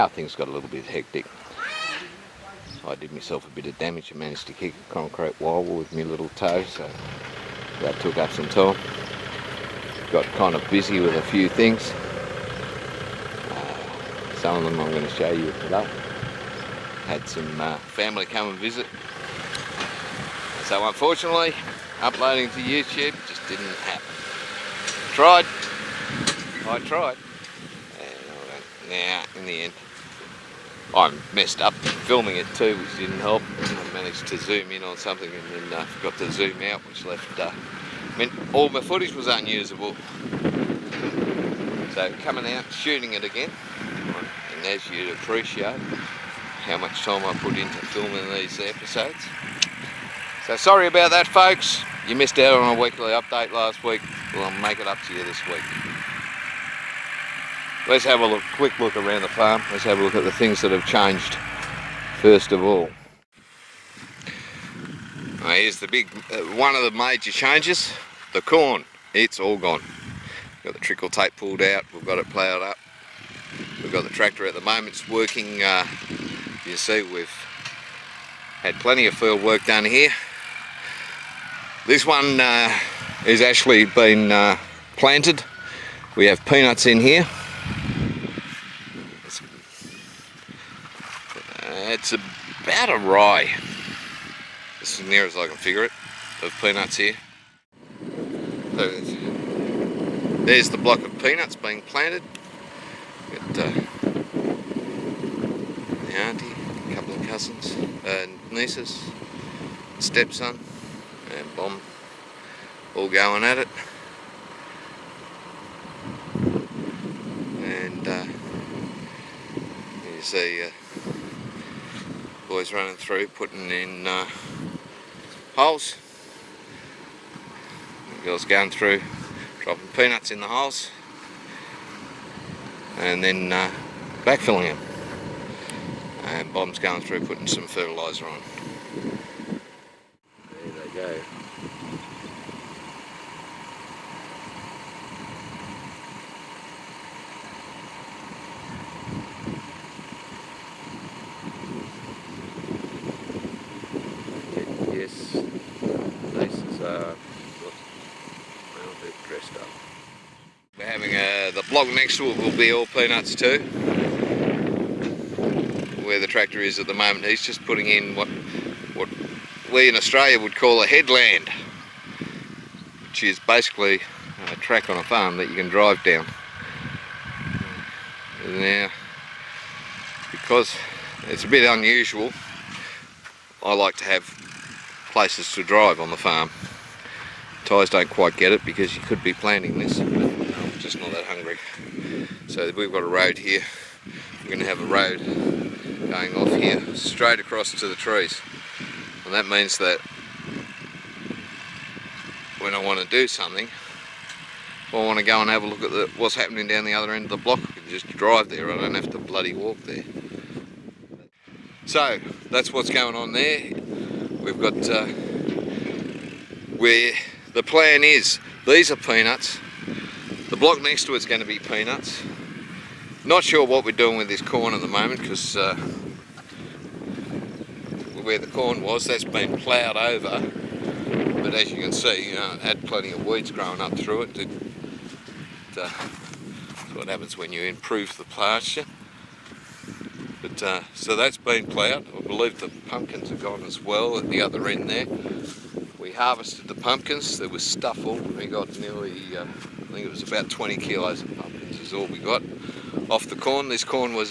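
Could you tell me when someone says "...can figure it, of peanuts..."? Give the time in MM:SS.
01:35.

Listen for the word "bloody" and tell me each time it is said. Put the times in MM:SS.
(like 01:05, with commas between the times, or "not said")
03:29.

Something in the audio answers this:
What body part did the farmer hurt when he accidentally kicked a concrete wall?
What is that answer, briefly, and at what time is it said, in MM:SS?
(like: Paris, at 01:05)
little toe, at 00:06.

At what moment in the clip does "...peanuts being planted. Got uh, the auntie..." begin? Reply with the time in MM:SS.
01:41.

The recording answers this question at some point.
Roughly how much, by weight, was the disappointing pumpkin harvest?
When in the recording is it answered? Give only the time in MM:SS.
04:10.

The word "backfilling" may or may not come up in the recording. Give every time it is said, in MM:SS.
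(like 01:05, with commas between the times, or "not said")
02:14.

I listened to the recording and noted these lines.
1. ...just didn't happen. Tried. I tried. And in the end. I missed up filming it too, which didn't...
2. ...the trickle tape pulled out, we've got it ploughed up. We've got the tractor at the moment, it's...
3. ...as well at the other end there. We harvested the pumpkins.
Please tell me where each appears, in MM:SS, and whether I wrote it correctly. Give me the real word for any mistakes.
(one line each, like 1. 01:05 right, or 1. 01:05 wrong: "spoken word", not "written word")
1. 00:23 wrong: "messed", not "missed"
2. 01:10 right
3. 04:03 right.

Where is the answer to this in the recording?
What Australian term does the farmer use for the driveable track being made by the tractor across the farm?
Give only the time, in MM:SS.
02:50.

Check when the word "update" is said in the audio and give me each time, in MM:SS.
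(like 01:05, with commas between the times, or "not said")
00:53.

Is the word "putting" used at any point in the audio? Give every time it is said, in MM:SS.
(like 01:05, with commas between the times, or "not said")
02:03, 02:17, 02:47.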